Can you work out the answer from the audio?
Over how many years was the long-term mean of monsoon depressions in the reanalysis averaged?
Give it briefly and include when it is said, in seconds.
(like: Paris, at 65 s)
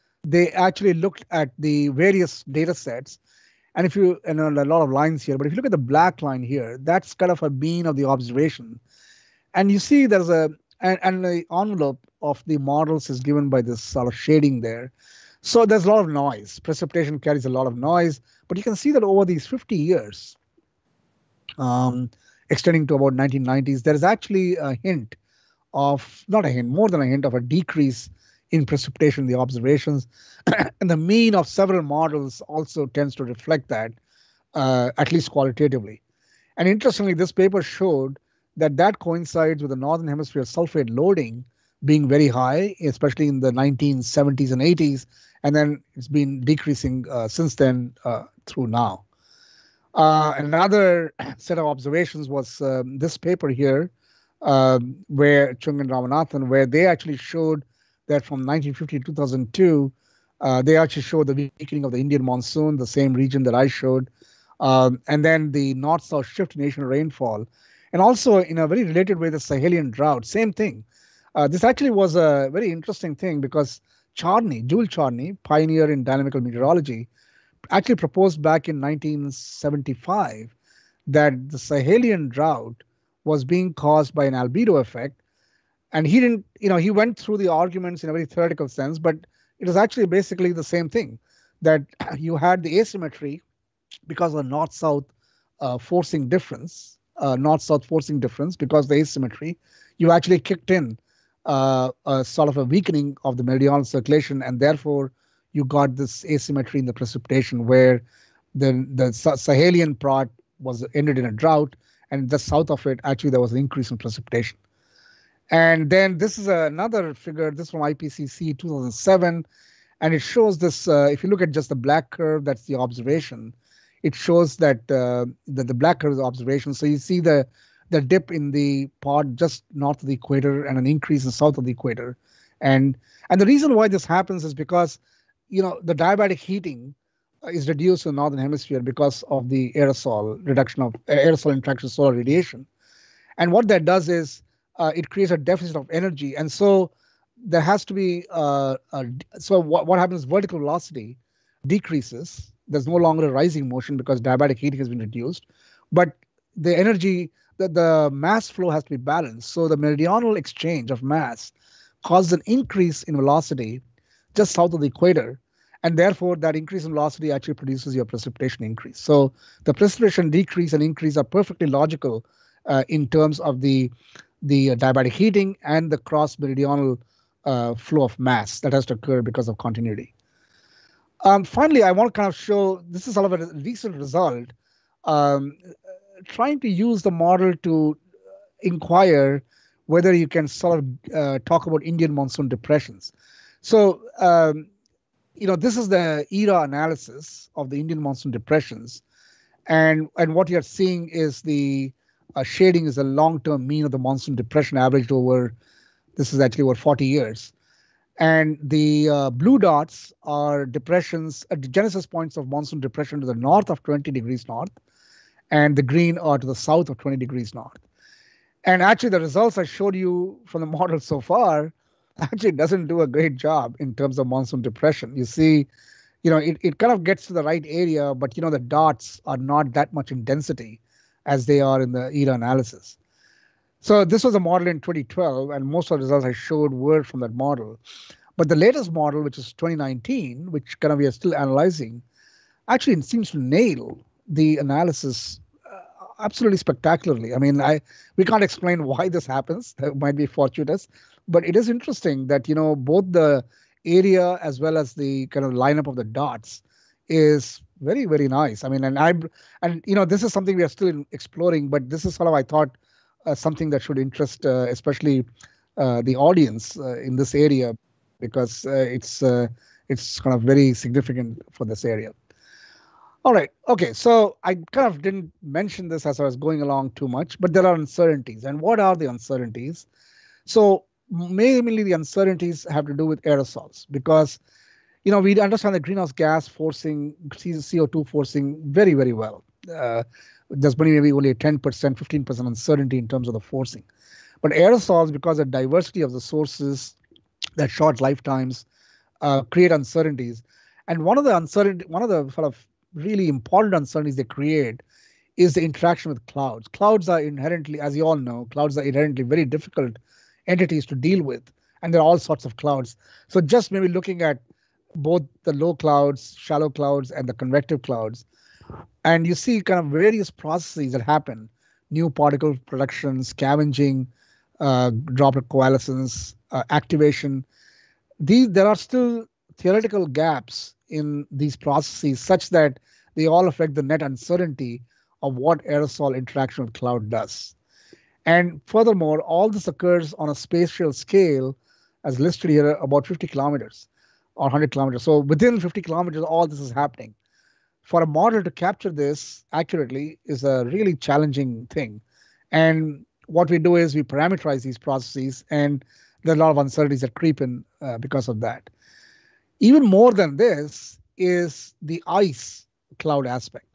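40 years, at 206 s.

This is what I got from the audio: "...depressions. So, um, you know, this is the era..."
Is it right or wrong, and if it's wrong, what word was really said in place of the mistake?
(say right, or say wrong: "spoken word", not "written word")
right.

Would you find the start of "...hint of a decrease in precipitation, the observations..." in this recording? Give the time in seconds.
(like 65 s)
27 s.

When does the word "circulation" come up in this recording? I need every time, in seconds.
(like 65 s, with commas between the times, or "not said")
103 s.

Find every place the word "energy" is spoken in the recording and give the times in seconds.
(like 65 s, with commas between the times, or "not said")
145 s, 156 s.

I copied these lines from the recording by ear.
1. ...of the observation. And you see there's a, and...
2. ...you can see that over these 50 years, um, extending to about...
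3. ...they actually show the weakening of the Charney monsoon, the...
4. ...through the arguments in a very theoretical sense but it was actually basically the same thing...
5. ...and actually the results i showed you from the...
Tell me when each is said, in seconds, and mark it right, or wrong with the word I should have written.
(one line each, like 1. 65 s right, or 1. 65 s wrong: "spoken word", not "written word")
1. 7 s right
2. 18 s right
3. 60 s wrong: "Indian", not "Charney"
4. 87 s right
5. 218 s right.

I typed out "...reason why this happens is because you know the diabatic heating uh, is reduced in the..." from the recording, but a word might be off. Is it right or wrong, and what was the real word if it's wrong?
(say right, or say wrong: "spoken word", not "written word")
right.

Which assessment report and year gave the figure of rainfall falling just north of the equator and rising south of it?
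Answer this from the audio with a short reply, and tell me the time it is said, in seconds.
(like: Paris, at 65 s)
IPCC 2007, at 117 s.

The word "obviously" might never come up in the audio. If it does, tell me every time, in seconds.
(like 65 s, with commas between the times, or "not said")
not said.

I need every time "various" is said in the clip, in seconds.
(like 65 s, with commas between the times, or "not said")
1 s, 319 s.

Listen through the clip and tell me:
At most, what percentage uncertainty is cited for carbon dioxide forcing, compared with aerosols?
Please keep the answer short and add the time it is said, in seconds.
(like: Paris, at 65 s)
15%, at 291 s.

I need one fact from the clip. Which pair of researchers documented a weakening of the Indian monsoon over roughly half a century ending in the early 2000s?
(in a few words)
Chung and Ramanathan.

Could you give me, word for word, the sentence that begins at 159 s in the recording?
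So the meridional exchange of mass causes an increase in velocity just south of the equator.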